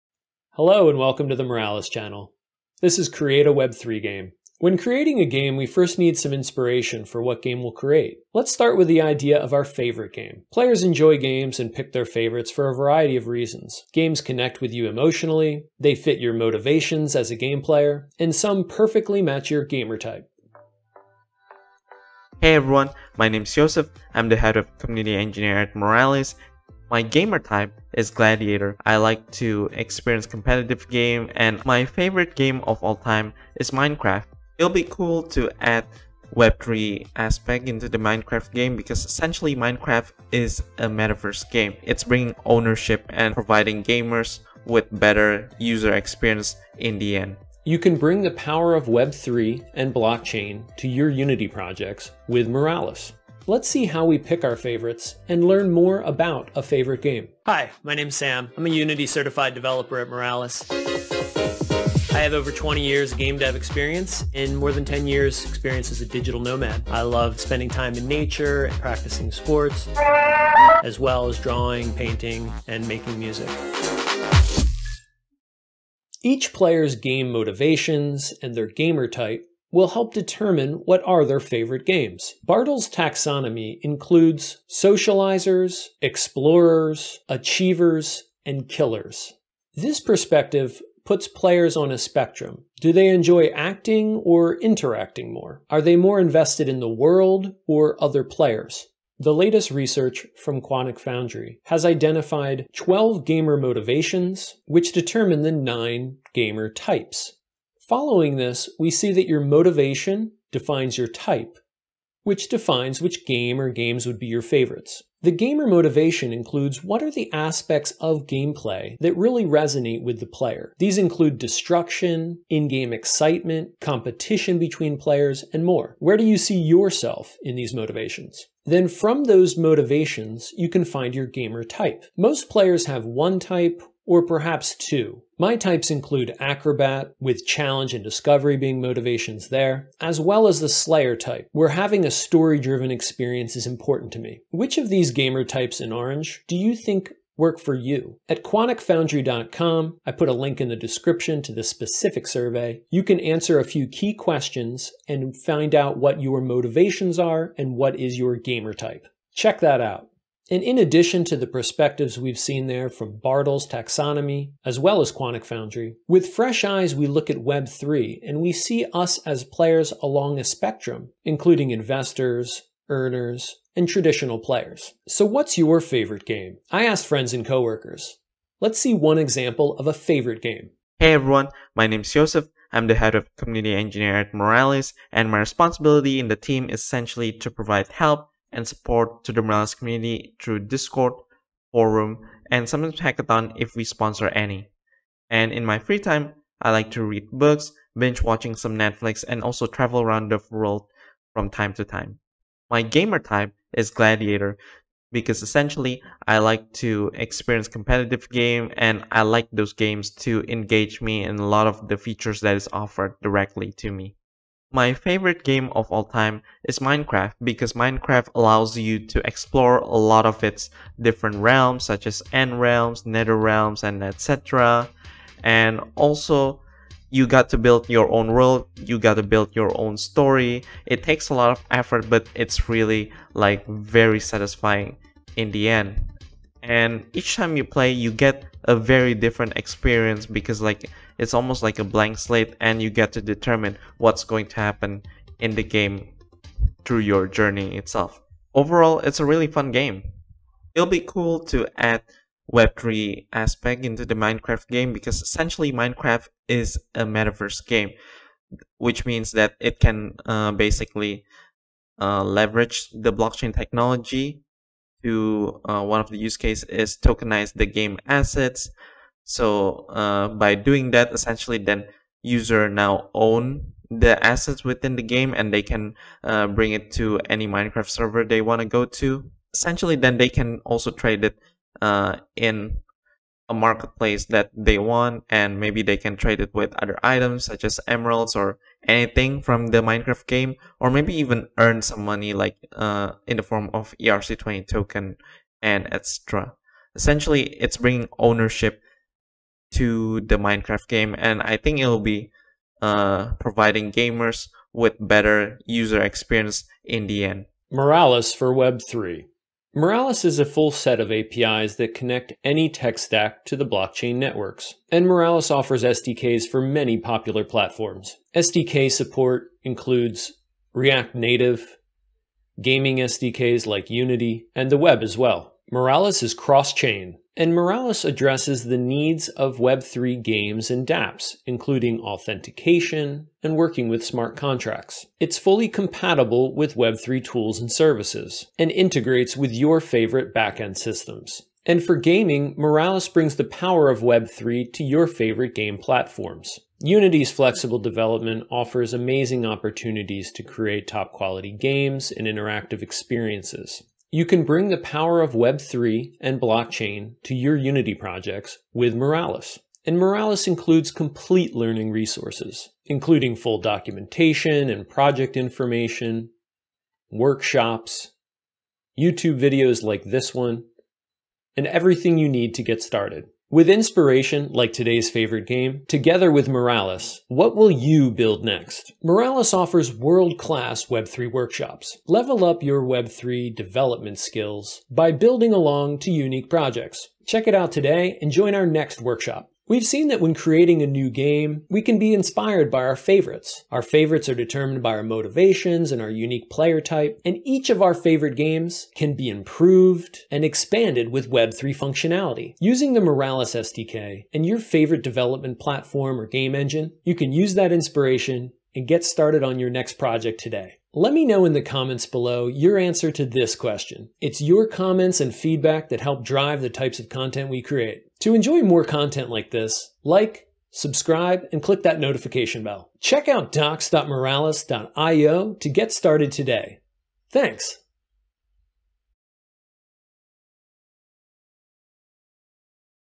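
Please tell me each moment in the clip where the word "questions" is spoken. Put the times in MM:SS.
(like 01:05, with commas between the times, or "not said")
02:34, 06:53.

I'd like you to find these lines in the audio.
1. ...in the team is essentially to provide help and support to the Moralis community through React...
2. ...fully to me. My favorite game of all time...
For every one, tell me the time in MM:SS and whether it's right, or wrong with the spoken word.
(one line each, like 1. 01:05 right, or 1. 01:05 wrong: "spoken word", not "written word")
1. 03:06 wrong: "Discord", not "React"
2. 03:33 wrong: "directly", not "fully".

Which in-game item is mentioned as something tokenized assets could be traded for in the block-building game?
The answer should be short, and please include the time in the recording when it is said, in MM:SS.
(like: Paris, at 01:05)
Emeralds, at 04:47.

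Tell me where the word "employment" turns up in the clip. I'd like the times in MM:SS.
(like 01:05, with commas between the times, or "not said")
not said.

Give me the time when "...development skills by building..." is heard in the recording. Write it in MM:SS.
06:23.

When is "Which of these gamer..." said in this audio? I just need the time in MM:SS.
02:24.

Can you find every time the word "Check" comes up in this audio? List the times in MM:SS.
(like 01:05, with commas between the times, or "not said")
02:39, 06:27, 07:02.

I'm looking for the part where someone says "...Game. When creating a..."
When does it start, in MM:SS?
00:04.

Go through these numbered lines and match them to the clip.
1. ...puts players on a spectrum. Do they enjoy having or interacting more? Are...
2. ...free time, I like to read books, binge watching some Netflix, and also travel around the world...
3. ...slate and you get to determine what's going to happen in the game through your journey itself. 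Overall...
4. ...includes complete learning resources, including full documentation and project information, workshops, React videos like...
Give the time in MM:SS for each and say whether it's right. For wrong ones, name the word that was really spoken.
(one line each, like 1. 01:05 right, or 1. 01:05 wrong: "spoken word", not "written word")
1. 01:31 wrong: "acting", not "having"
2. 03:15 right
3. 04:02 right
4. 06:00 wrong: "YouTube", not "React".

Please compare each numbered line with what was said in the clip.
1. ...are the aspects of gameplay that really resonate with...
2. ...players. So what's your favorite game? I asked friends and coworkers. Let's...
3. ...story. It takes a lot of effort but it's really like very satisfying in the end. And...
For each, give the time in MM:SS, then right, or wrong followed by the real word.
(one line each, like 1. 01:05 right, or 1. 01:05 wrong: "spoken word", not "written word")
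1. 01:57 right
2. 02:54 right
3. 03:49 right.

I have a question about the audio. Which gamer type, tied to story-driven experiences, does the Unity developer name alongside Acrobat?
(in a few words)
Slayer.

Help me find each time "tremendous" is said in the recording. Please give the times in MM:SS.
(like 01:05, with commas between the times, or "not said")
not said.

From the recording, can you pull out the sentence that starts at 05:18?
SDK support includes React Native, gaming SDKs like Unity, and the web as well.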